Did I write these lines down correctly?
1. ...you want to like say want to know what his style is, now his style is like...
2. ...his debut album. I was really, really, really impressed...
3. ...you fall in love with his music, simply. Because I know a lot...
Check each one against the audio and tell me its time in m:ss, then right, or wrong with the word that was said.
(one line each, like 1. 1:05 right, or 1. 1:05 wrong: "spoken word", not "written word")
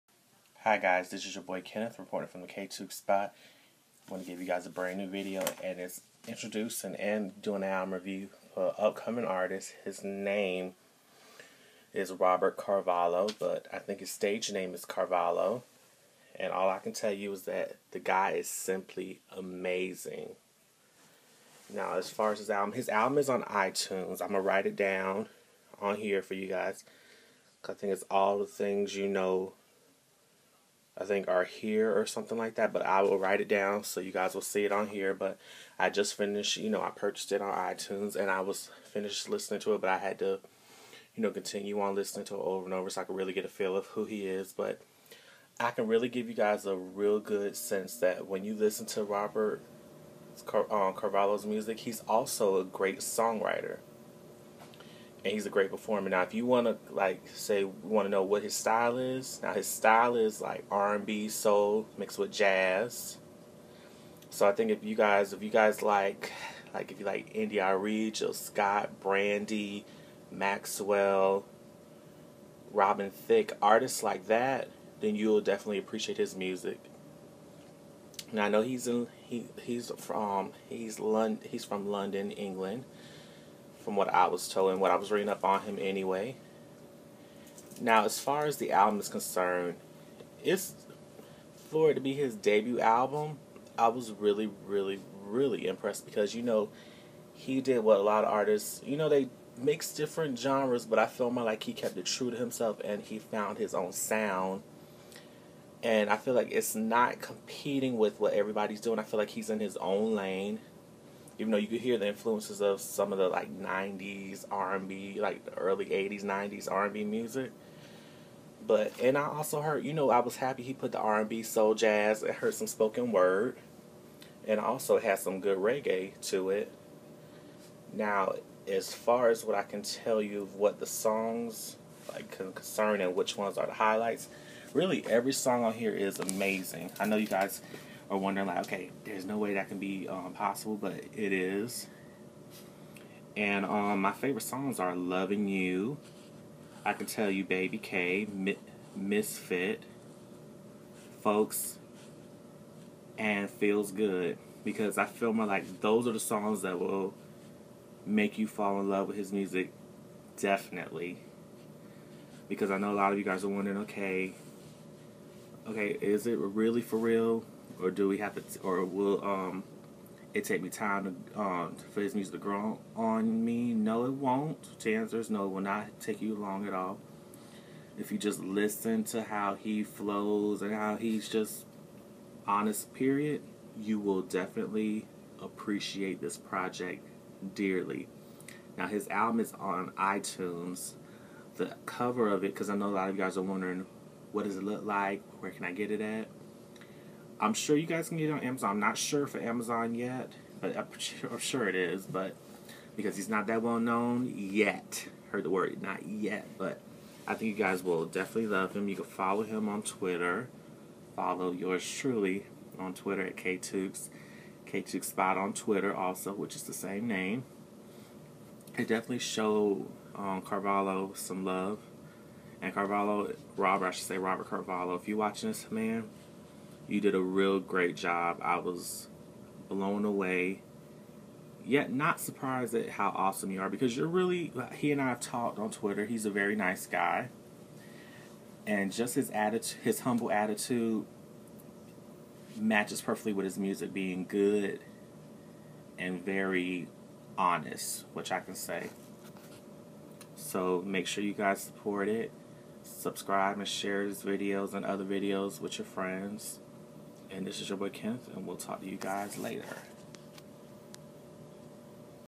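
1. 0:56 right
2. 1:32 right
3. 2:38 wrong: "definitely", not "simply".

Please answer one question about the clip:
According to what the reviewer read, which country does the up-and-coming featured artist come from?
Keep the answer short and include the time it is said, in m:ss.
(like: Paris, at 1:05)
England, at 1:22.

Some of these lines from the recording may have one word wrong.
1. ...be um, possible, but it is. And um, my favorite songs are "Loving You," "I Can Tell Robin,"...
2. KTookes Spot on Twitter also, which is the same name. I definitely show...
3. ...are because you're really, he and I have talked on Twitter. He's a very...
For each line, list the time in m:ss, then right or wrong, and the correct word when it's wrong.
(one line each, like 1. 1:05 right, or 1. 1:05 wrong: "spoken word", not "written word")
1. 2:19 wrong: "You", not "Robin"
2. 3:34 right
3. 3:53 right.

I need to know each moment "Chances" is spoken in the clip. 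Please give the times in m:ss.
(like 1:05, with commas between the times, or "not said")
2:54.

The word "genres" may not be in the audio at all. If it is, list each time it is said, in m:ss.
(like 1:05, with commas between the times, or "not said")
1:40.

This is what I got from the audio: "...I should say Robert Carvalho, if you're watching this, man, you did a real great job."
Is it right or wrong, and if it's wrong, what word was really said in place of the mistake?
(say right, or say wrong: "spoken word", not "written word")
right.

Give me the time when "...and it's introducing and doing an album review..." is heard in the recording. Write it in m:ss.
0:05.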